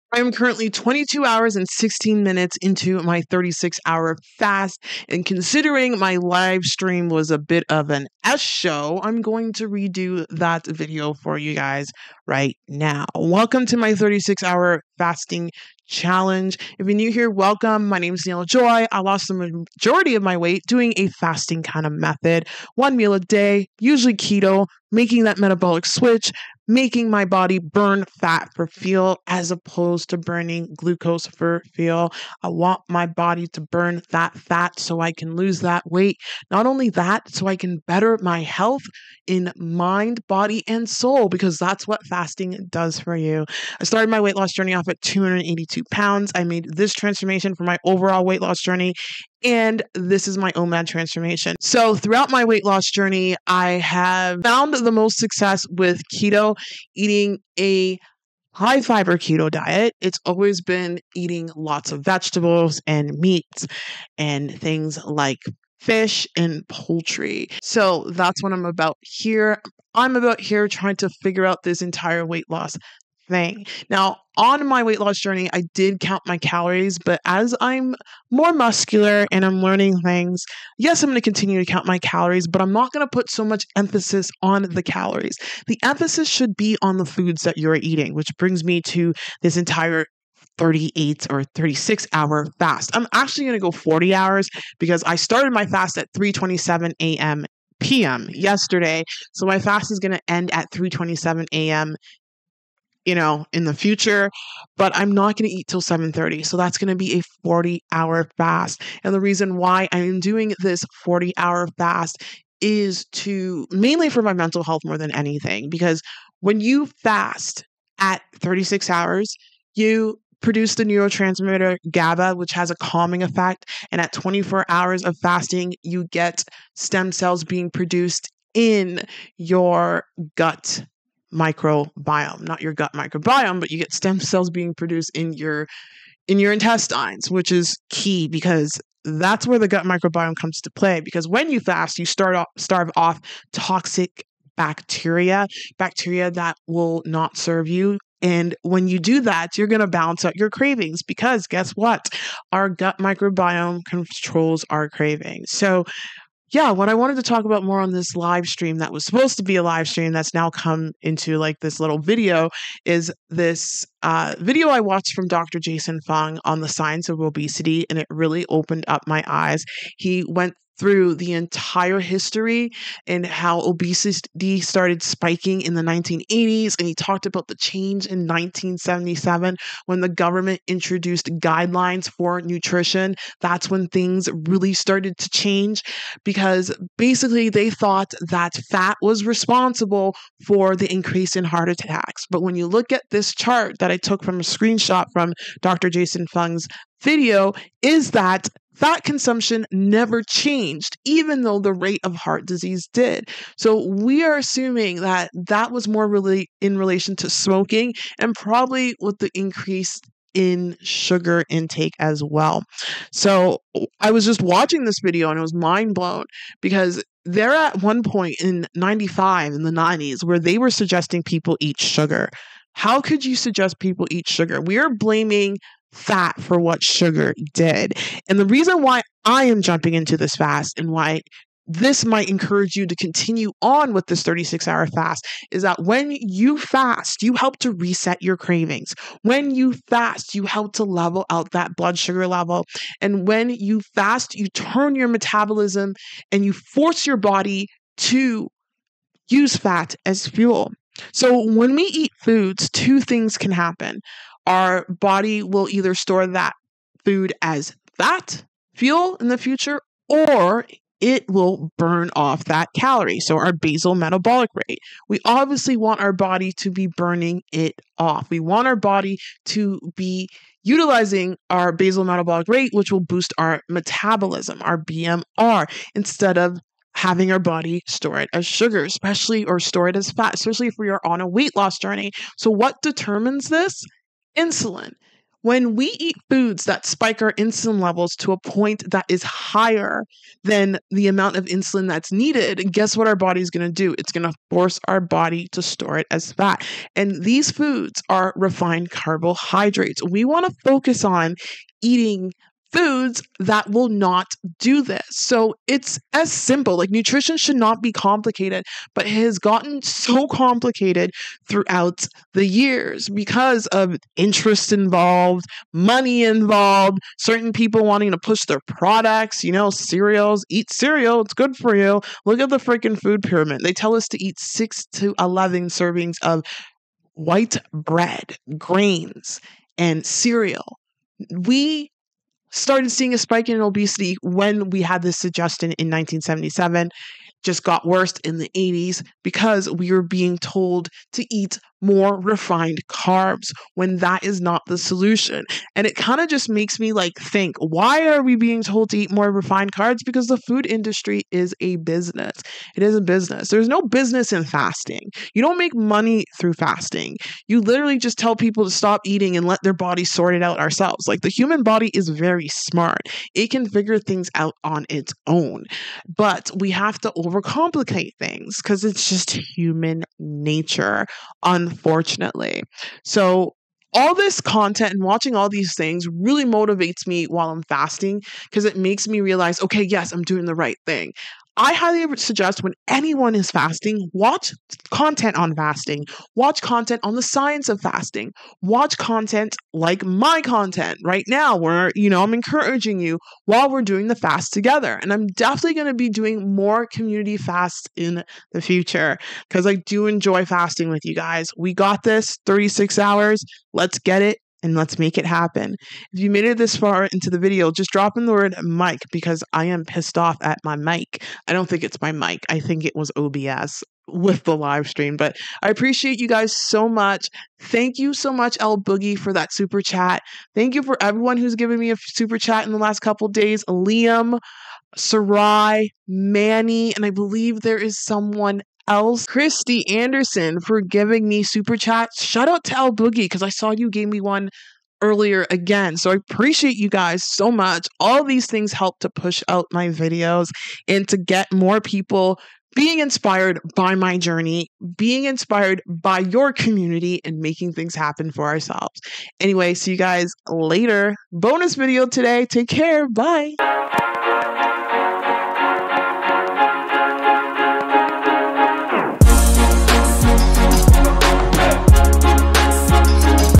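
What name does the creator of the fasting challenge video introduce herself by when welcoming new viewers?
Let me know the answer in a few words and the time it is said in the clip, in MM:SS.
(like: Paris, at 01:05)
Daniella Joy, at 00:18.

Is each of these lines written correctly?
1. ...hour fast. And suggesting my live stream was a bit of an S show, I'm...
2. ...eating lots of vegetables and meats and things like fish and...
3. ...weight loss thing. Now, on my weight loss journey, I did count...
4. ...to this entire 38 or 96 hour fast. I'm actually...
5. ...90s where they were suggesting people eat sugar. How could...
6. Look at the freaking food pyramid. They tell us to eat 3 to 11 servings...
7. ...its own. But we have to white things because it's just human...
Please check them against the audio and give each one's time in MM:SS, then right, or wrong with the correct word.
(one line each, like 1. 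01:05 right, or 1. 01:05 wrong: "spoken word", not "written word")
1. 00:03 wrong: "considering", not "suggesting"
2. 01:01 right
3. 01:12 right
4. 01:28 wrong: "36", not "96"
5. 03:39 right
6. 05:22 wrong: "6", not "3"
7. 06:04 wrong: "overcomplicate", not "white".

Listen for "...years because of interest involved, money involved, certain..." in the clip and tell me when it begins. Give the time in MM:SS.
05:12.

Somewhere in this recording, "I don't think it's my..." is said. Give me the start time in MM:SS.
06:51.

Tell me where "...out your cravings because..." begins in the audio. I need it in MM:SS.
02:30.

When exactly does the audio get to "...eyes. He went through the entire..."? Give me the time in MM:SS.
02:49.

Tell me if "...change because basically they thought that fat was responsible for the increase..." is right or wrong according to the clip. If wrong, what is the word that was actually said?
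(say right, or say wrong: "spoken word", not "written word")
right.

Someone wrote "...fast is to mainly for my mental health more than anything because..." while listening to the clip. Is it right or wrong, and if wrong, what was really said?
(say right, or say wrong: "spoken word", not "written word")
right.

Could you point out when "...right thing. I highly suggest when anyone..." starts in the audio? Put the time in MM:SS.
06:20.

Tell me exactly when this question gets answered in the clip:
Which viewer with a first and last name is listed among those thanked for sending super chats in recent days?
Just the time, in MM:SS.
07:09.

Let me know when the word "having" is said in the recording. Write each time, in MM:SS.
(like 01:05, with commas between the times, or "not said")
04:36.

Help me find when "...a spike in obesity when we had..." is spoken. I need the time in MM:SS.
05:33.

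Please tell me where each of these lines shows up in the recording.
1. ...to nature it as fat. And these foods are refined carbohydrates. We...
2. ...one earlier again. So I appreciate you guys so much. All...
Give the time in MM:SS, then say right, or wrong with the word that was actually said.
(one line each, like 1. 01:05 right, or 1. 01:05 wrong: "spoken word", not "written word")
1. 04:55 wrong: "store", not "nature"
2. 07:14 right.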